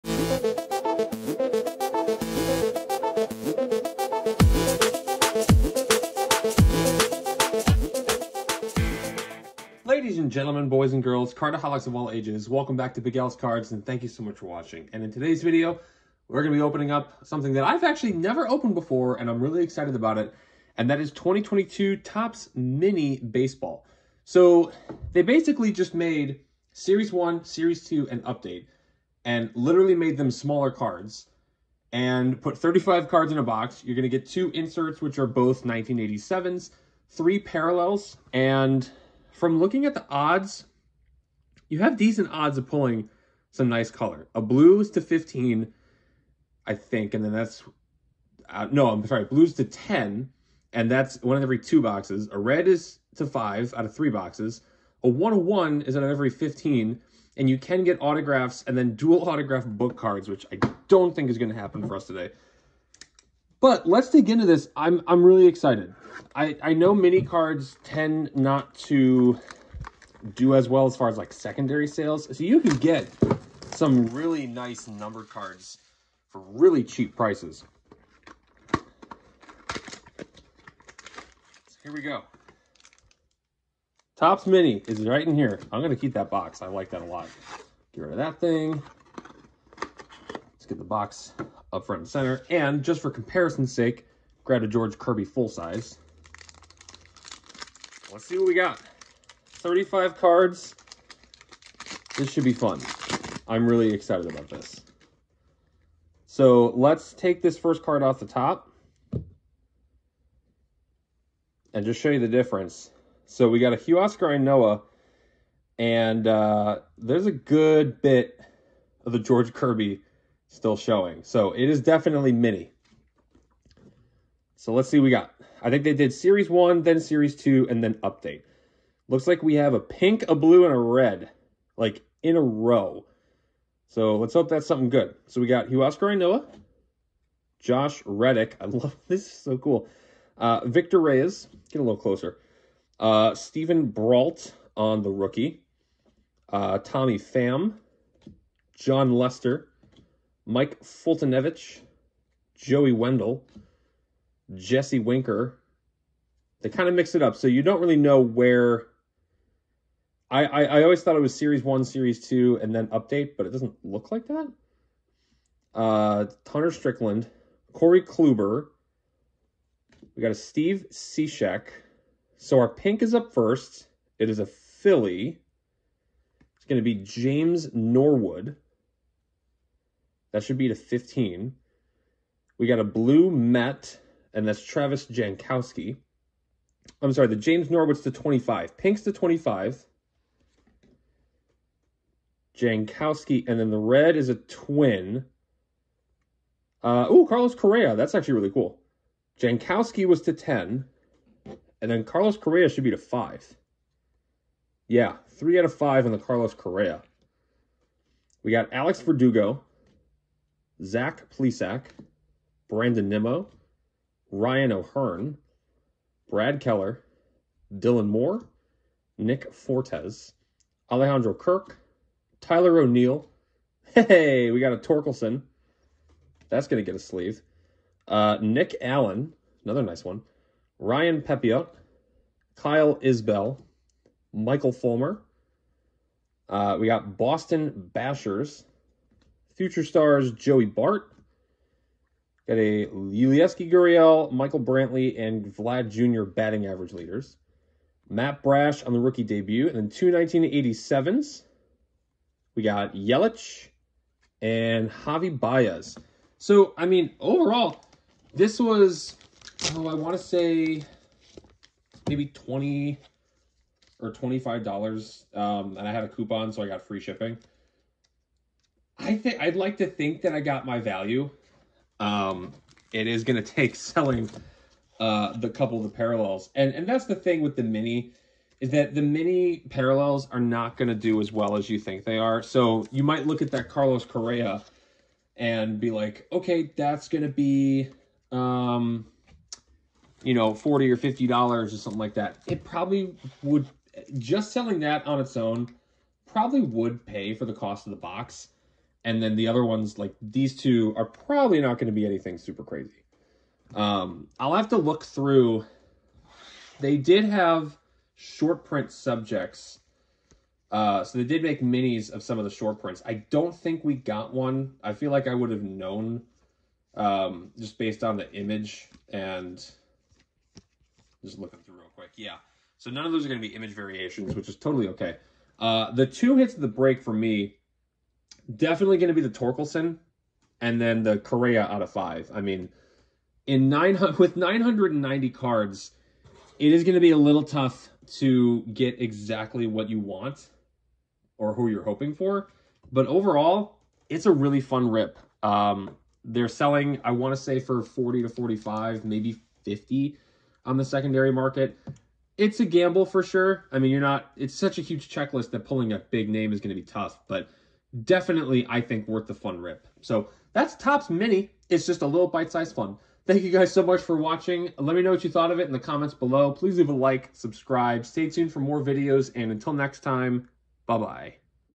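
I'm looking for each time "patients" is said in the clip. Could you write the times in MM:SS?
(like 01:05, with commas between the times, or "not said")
not said.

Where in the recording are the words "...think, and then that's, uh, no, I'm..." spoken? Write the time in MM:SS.
00:46.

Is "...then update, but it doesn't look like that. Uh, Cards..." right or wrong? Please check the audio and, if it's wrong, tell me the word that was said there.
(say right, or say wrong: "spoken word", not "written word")
wrong: "Strickland", not "Cards".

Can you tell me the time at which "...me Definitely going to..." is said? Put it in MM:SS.
05:27.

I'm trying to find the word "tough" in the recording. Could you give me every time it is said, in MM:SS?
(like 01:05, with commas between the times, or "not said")
05:37, 05:56.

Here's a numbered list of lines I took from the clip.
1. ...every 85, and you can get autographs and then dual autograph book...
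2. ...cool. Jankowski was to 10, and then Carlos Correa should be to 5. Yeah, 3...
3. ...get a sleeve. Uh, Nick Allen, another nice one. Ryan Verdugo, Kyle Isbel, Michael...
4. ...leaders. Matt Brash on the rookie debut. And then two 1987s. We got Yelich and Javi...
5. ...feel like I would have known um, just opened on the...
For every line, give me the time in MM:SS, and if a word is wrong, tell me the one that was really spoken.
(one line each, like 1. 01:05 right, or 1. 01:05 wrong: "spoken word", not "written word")
1. 00:56 wrong: "15", not "85"
2. 03:18 right
3. 03:46 wrong: "Pepiot", not "Verdugo"
4. 04:06 right
5. 05:14 wrong: "based", not "opened".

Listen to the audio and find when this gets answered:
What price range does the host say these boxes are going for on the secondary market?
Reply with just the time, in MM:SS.
05:47.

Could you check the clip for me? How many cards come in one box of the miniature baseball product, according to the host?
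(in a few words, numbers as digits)
35.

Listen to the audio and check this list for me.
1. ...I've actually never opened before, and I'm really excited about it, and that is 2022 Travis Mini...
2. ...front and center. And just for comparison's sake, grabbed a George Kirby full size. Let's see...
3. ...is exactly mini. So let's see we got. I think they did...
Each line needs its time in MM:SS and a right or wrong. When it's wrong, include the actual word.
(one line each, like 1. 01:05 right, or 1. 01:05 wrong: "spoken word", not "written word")
1. 00:17 wrong: "Topps", not "Travis"
2. 01:31 right
3. 02:01 wrong: "definitely", not "exactly".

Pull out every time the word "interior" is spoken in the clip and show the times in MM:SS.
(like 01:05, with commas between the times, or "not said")
not said.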